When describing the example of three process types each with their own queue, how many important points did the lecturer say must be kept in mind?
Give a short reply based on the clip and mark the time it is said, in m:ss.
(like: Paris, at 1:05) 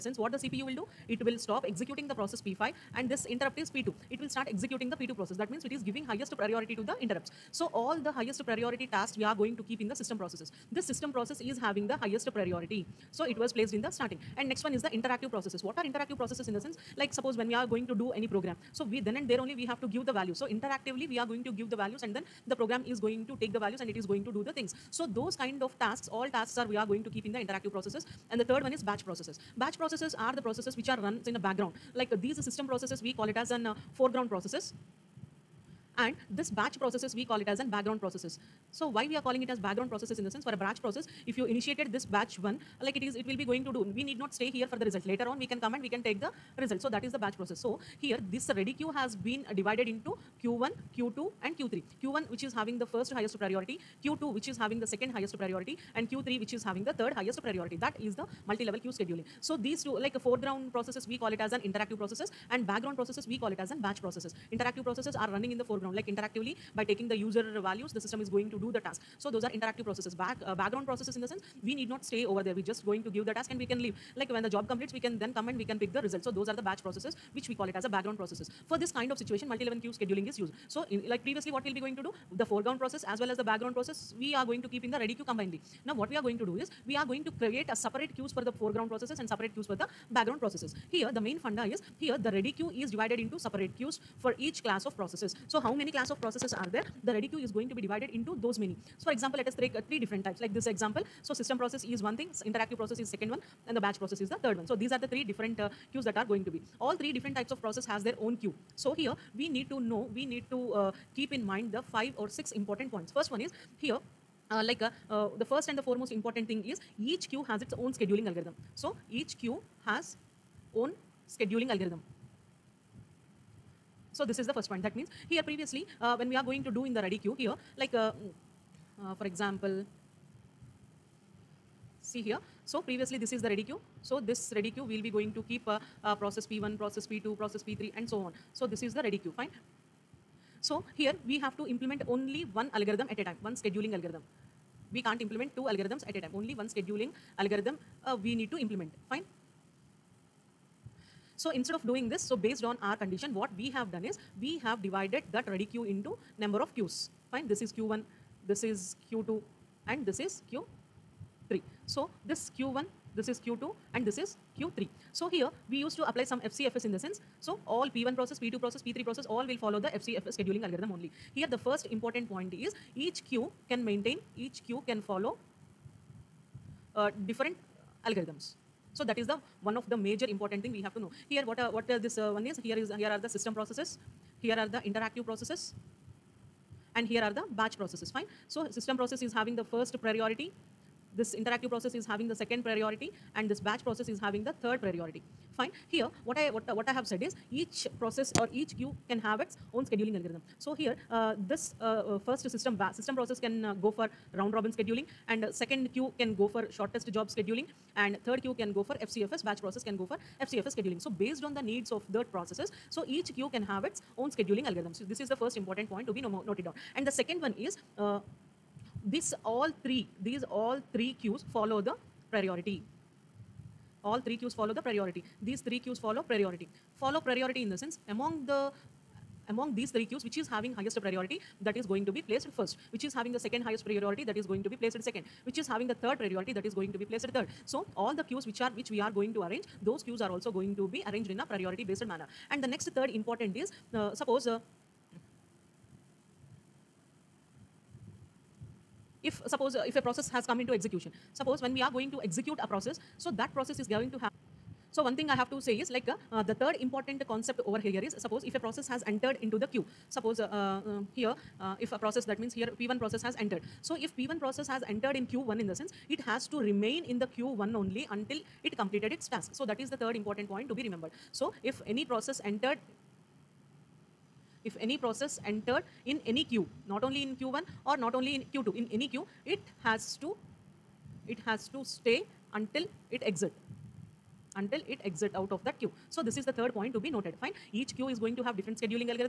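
5 or 6, at 1:51.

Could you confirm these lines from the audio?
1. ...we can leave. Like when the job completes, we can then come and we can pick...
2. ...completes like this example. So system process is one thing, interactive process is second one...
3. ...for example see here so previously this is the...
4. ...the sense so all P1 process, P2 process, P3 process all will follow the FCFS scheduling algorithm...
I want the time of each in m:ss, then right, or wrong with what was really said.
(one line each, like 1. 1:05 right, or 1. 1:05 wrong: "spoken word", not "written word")
1. 1:13 right
2. 1:40 wrong: "types", not "completes"
3. 2:09 right
4. 2:46 right.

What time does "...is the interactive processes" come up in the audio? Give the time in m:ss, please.
0:14.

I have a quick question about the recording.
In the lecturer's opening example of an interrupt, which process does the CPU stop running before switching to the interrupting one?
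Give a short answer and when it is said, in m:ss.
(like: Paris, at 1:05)
P5, at 0:02.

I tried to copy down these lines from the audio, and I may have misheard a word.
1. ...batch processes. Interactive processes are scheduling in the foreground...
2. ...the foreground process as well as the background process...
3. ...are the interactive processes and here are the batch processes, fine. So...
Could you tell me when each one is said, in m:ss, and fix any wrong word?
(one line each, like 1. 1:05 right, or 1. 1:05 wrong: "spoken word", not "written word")
1. 1:03 wrong: "running", not "scheduling"
2. 1:22 right
3. 3:04 right.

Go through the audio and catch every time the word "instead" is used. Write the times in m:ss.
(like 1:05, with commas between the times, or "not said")
2:31.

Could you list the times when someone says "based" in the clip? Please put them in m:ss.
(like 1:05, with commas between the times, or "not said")
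2:32, 3:31, 4:01.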